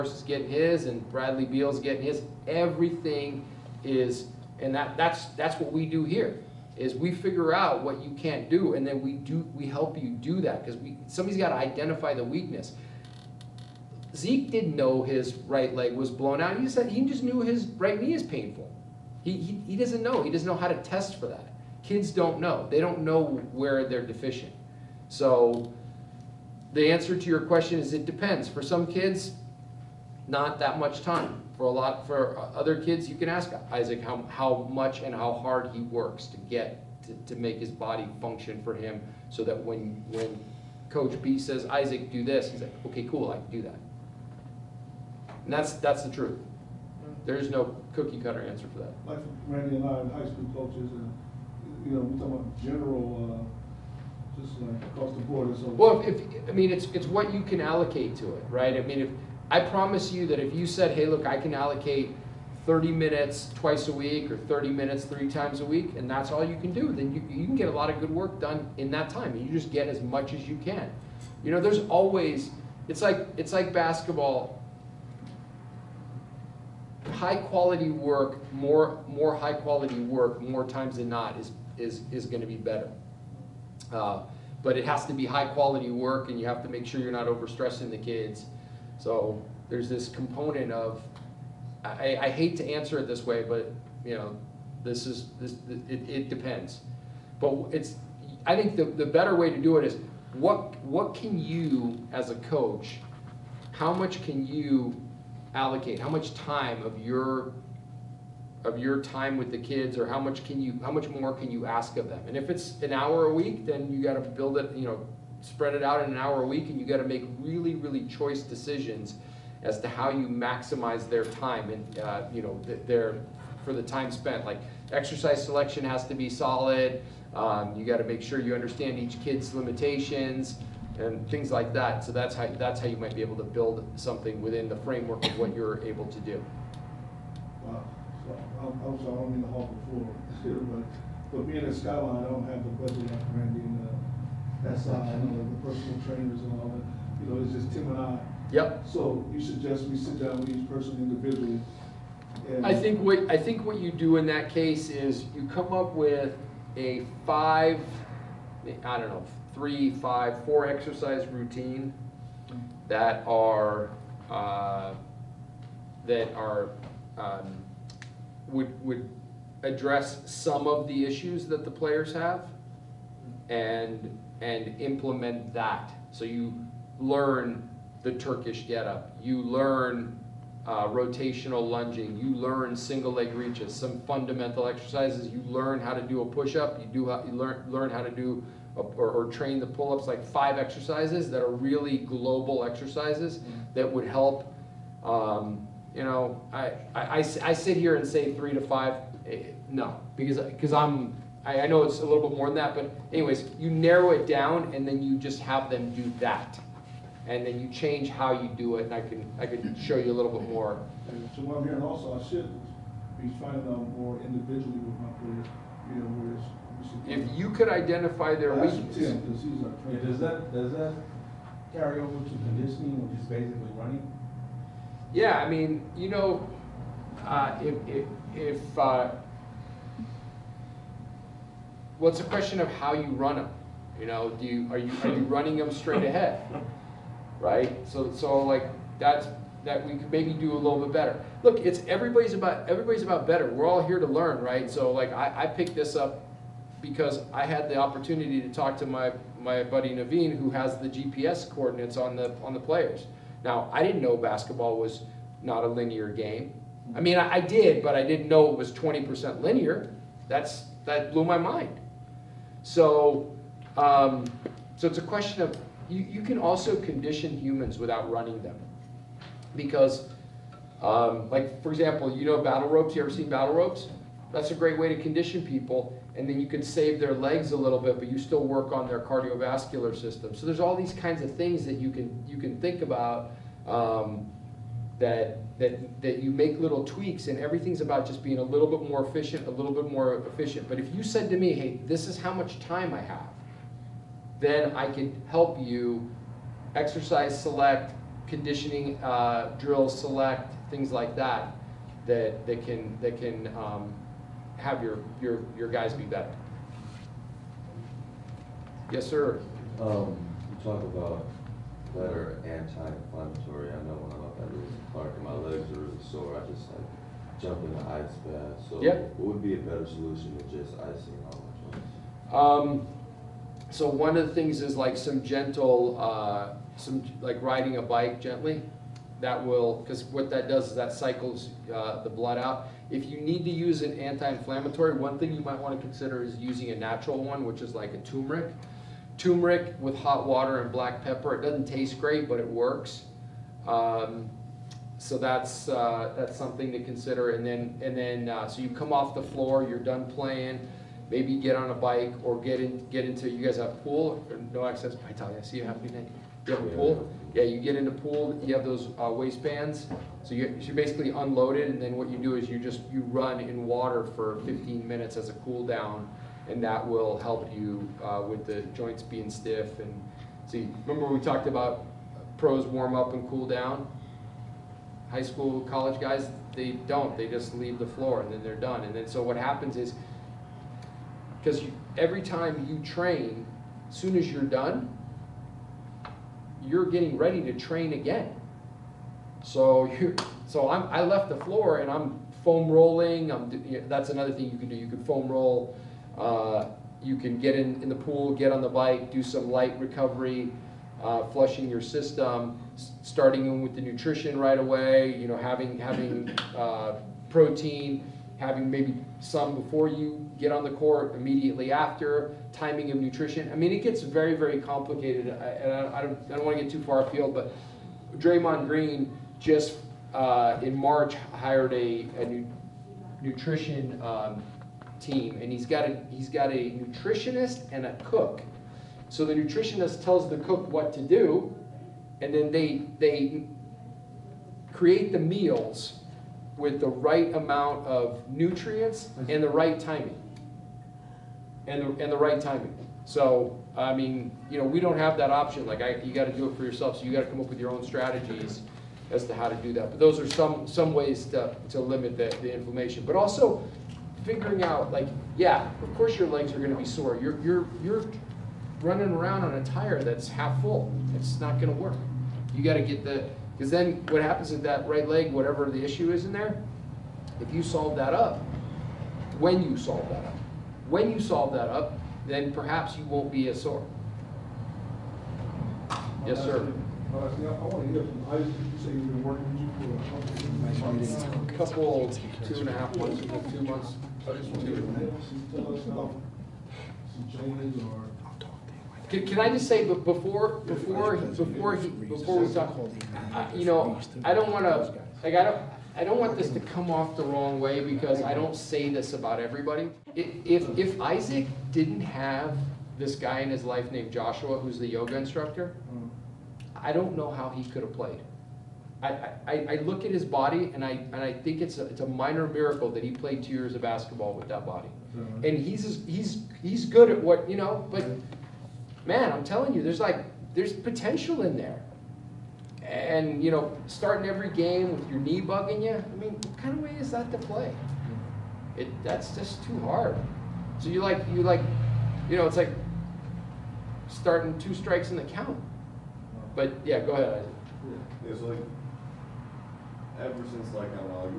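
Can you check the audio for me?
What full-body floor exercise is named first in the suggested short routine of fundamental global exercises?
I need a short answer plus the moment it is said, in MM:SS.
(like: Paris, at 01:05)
Turkish getup, at 02:58.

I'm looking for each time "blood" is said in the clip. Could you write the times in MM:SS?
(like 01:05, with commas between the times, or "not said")
05:32.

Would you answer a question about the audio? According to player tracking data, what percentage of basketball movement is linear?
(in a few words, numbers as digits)
20%.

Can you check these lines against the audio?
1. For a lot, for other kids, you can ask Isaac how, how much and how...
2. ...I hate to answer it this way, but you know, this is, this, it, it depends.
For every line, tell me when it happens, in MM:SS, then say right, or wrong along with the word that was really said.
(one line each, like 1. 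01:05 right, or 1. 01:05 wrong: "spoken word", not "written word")
1. 00:31 right
2. 01:32 right.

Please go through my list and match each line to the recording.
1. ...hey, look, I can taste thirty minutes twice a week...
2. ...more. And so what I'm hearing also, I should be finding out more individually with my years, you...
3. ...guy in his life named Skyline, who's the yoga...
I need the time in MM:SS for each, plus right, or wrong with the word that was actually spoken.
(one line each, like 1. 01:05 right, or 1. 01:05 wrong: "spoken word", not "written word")
1. 01:00 wrong: "allocate", not "taste"
2. 03:30 wrong: "players", not "years"
3. 08:23 wrong: "Joshua", not "Skyline".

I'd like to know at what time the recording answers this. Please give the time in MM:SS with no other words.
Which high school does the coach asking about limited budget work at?
02:21.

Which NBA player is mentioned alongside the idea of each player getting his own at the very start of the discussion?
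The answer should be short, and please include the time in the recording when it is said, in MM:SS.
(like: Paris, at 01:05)
Bradley Beal, at 00:01.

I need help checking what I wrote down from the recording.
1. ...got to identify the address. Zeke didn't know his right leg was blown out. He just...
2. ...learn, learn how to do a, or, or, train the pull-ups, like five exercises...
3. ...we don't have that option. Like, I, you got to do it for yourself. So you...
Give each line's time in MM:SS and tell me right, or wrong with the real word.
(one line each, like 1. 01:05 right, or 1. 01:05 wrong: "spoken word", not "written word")
1. 00:11 wrong: "weakness", not "address"
2. 03:07 right
3. 07:24 right.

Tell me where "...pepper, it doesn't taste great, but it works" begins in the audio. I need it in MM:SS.
05:41.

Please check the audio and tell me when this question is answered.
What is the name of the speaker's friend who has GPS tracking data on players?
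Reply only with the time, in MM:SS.
04:09.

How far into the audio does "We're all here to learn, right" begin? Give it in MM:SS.
04:03.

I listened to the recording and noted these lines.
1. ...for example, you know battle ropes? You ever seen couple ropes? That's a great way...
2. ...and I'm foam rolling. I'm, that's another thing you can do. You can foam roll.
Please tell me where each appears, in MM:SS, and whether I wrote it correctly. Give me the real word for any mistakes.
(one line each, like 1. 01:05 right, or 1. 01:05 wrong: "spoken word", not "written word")
1. 04:31 wrong: "battle", not "couple"
2. 06:31 right.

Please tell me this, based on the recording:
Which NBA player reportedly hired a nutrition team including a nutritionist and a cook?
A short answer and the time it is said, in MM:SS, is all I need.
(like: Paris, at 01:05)
Draymond Green, at 06:58.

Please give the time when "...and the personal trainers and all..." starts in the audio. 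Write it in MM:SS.
02:24.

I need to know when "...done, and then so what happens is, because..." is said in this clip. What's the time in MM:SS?
06:18.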